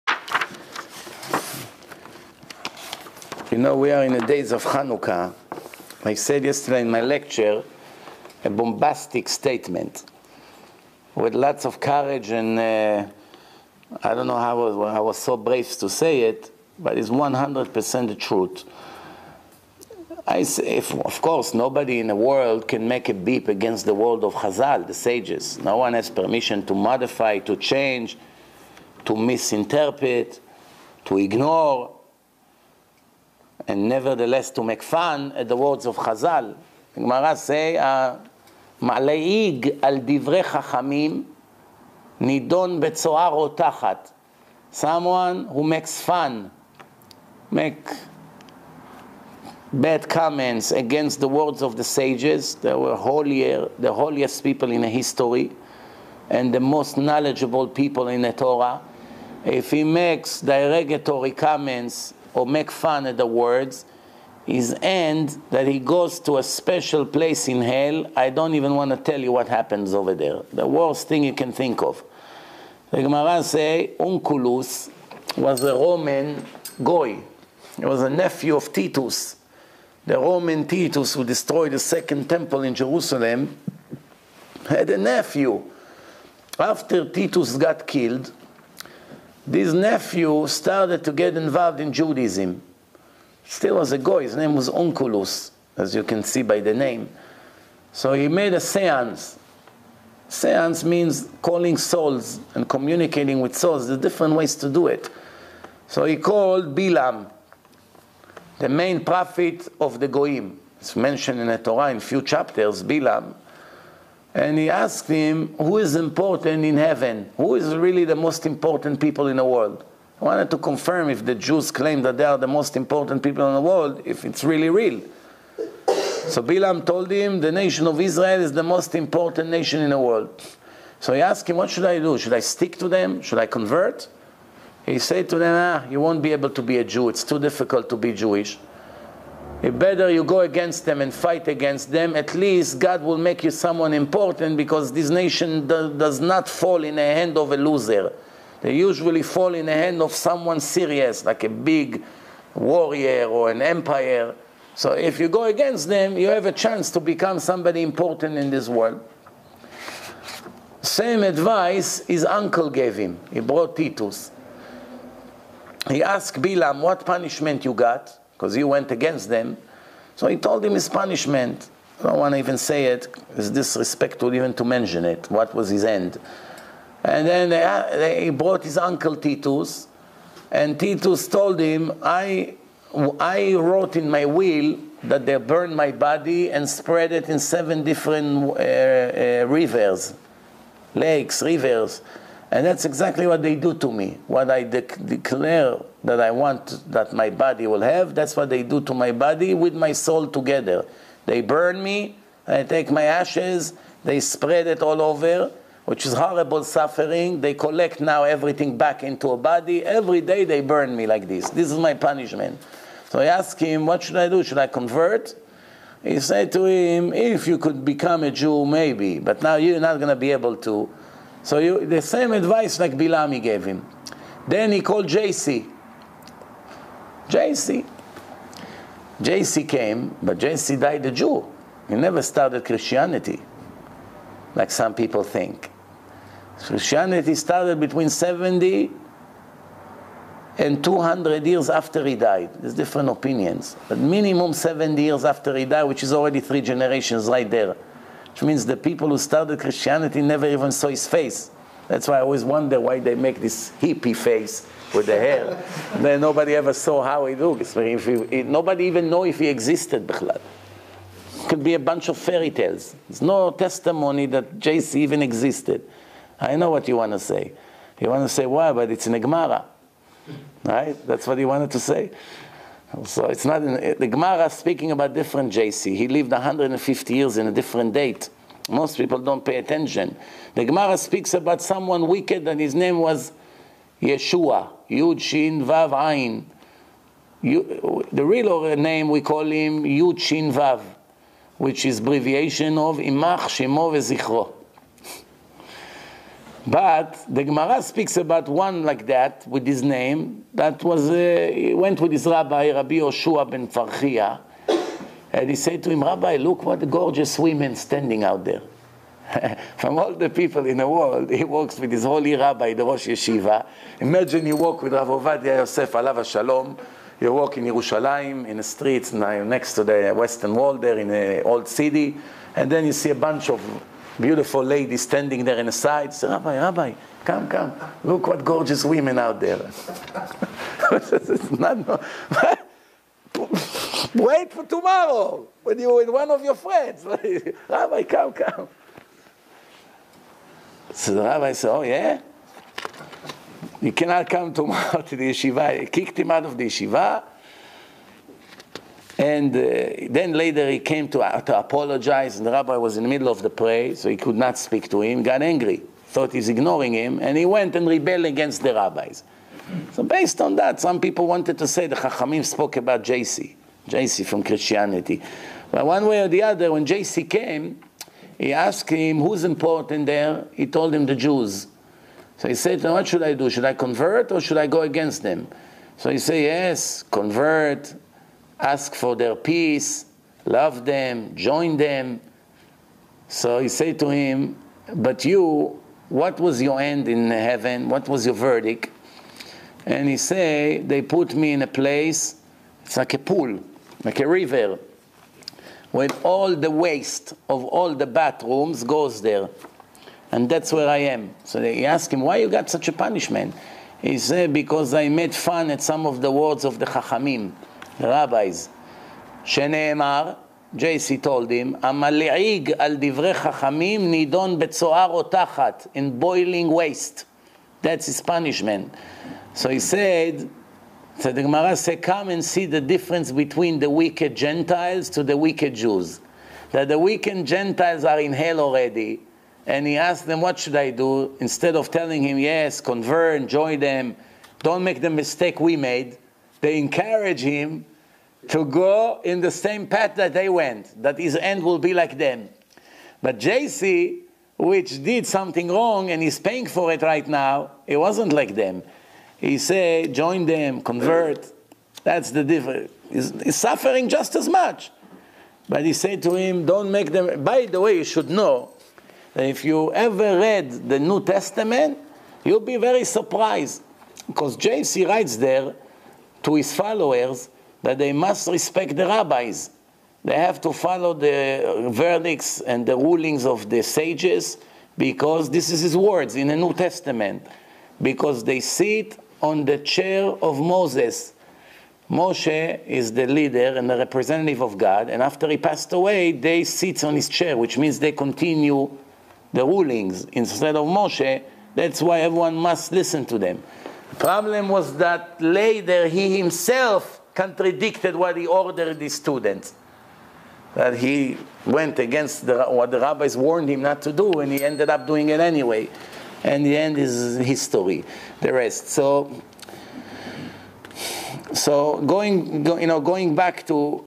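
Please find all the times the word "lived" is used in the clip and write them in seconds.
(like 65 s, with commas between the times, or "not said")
276 s.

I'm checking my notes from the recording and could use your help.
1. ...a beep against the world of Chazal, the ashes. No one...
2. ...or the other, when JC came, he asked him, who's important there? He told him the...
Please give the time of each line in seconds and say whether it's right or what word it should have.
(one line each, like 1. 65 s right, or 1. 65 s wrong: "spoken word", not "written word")
1. 23 s wrong: "sages", not "ashes"
2. 366 s right.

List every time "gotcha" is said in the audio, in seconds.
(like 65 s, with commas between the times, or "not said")
not said.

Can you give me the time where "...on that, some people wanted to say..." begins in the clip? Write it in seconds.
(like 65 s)
360 s.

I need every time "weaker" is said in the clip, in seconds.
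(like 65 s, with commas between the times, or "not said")
not said.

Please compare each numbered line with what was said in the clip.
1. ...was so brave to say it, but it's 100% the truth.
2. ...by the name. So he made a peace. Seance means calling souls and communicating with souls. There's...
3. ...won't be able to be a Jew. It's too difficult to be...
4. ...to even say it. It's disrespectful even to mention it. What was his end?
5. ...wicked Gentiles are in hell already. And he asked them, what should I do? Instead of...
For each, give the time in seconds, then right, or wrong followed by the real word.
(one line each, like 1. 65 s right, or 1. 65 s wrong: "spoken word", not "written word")
1. 15 s right
2. 96 s wrong: "seance", not "peace"
3. 135 s right
4. 172 s right
5. 426 s right.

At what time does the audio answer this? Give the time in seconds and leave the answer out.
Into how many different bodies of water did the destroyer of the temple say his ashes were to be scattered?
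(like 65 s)
187 s.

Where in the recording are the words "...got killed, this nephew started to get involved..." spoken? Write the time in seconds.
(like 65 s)
87 s.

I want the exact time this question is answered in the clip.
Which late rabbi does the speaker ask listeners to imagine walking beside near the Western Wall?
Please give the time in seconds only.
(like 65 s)
314 s.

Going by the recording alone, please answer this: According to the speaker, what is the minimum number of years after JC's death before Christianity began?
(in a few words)
70.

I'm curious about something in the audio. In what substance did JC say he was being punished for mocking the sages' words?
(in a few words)
Boiling waste.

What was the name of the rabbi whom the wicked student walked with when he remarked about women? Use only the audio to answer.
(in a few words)
Rabbi Yoshua ben Farchia.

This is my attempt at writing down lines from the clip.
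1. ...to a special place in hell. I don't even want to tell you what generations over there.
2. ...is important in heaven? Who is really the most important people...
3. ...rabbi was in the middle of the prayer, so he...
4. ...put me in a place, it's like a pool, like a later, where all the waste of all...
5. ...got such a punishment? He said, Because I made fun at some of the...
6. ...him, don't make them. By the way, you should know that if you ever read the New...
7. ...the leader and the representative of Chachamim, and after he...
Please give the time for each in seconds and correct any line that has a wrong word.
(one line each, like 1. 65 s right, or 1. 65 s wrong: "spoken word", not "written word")
1. 66 s wrong: "happens", not "generations"
2. 115 s right
3. 352 s right
4. 391 s wrong: "river", not "later"
5. 402 s right
6. 456 s right
7. 483 s wrong: "God", not "Chachamim".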